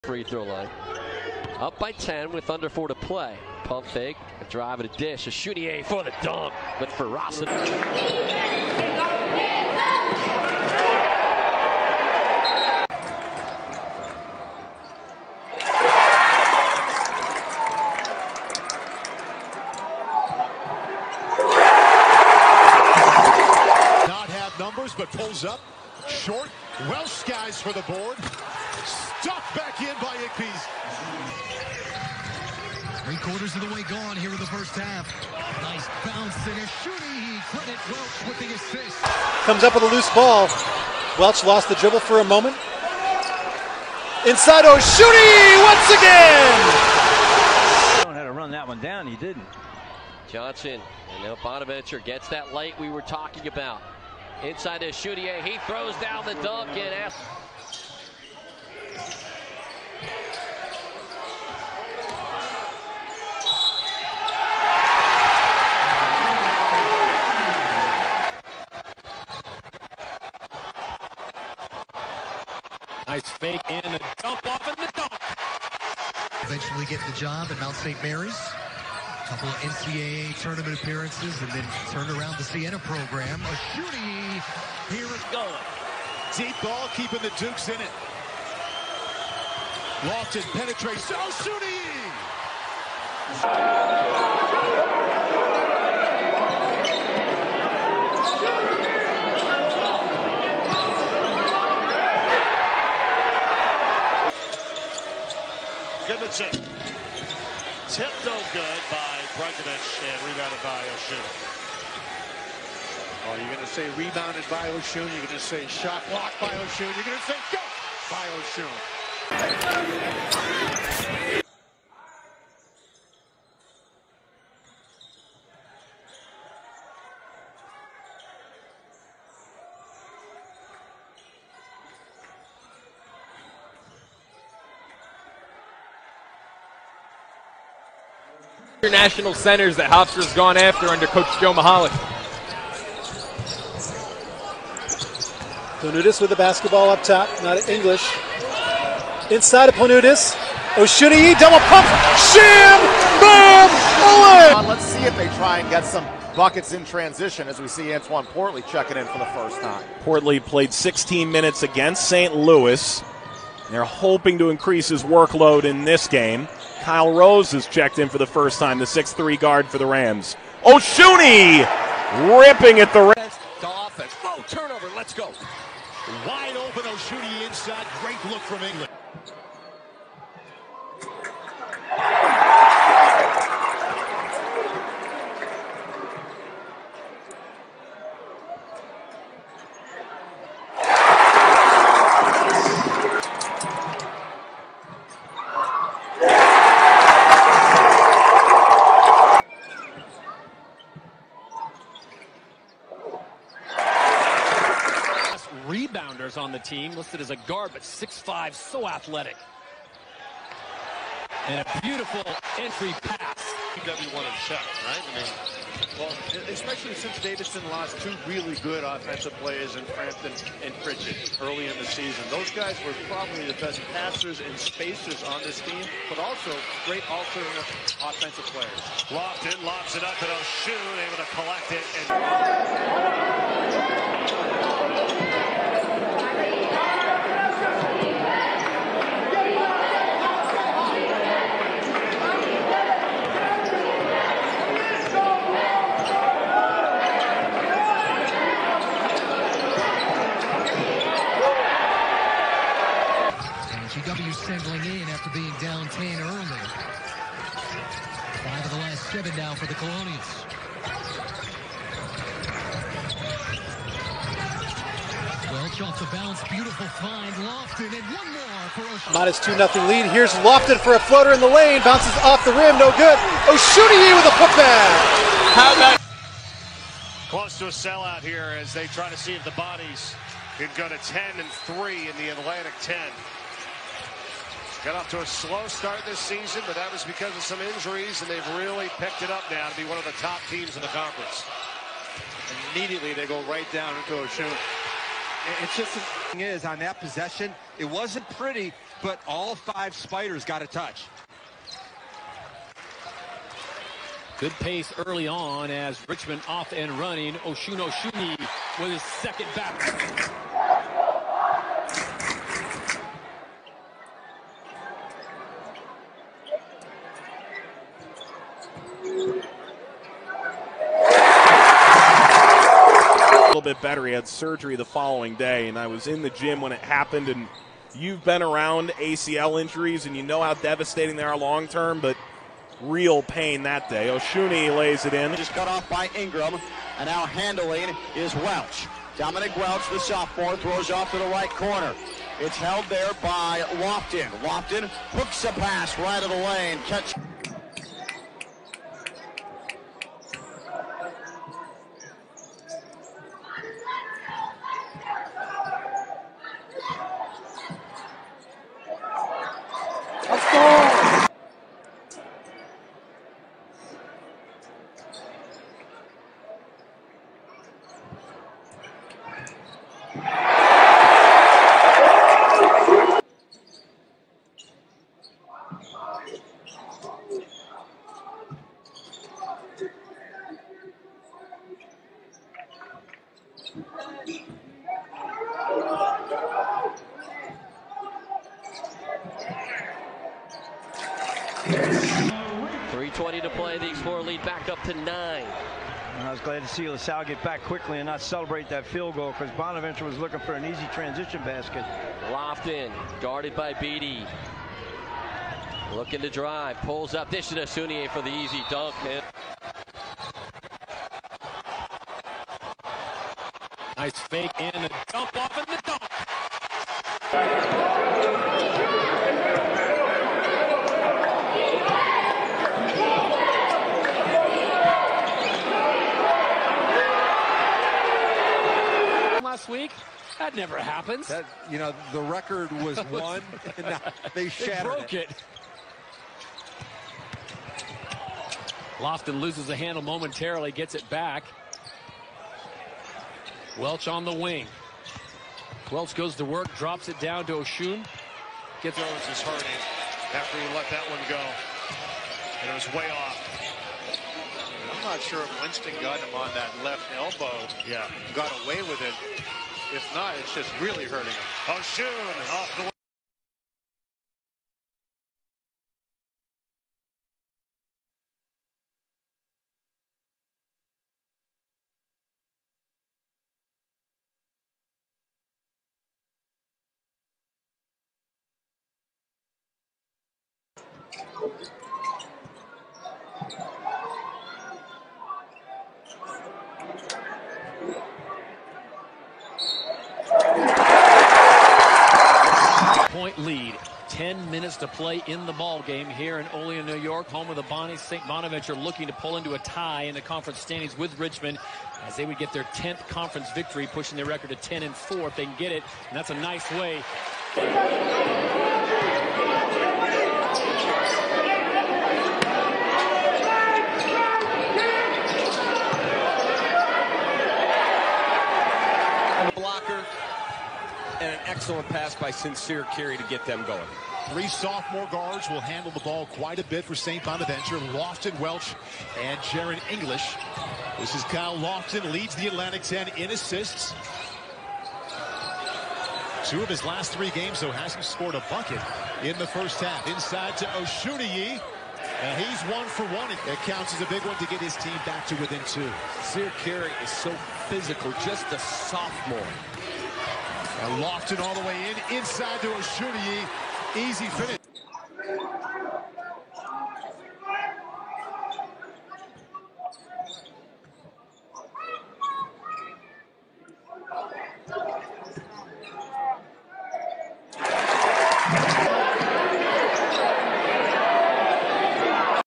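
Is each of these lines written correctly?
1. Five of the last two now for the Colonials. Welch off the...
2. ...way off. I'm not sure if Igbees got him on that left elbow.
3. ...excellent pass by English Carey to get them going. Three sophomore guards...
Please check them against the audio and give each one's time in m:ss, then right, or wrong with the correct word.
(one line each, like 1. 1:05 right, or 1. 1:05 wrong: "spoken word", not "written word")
1. 4:18 wrong: "seven", not "two"
2. 7:32 wrong: "Winston", not "Igbees"
3. 8:41 wrong: "Sincere", not "English".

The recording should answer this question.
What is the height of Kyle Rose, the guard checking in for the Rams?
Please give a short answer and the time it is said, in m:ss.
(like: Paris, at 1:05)
6-3, at 2:48.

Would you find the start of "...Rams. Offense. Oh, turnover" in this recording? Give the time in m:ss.
2:53.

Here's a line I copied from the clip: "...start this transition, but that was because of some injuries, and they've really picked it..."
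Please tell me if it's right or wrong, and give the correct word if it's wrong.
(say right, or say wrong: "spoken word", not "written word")
wrong: "season", not "transition".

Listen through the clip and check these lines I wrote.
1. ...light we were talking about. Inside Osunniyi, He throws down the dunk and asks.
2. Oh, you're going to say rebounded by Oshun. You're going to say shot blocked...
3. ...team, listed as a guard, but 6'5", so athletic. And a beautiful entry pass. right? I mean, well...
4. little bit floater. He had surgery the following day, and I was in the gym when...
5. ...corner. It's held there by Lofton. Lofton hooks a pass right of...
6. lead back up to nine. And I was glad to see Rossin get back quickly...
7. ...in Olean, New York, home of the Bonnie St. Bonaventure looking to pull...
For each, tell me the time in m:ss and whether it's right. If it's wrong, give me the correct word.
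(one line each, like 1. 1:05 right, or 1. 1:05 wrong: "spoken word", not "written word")
1. 0:52 right
2. 1:53 right
3. 3:26 right
4. 5:23 wrong: "better", not "floater"
5. 5:41 right
6. 6:34 wrong: "LaSalle", not "Rossin"
7. 8:16 right.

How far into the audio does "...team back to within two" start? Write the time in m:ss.
9:04.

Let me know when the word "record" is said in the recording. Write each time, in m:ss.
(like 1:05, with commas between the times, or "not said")
7:12, 8:24.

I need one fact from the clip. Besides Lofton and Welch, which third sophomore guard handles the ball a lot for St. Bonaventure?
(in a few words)
Jaren English.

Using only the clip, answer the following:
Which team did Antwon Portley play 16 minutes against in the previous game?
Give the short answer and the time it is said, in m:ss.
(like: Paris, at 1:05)
St. Louis, at 2:42.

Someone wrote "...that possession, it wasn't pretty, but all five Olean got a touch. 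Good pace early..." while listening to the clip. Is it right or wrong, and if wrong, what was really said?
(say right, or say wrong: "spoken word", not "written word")
wrong: "Spiders", not "Olean".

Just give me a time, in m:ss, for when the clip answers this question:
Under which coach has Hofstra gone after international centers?
2:21.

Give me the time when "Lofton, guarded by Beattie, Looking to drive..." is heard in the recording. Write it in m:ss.
6:42.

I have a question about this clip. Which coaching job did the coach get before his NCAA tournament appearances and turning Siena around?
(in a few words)
Mount St. Mary's.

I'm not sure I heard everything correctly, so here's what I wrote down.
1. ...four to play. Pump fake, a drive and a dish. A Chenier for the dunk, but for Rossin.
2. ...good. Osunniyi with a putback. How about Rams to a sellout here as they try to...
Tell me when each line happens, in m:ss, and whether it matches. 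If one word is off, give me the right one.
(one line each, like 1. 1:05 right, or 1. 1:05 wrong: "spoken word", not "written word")
1. 0:02 right
2. 4:32 wrong: "Close", not "Rams".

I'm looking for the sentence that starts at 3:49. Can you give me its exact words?
Lofton lofts it up and a shoot, able to collect it.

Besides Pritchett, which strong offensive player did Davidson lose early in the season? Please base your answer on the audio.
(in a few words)
Frampton.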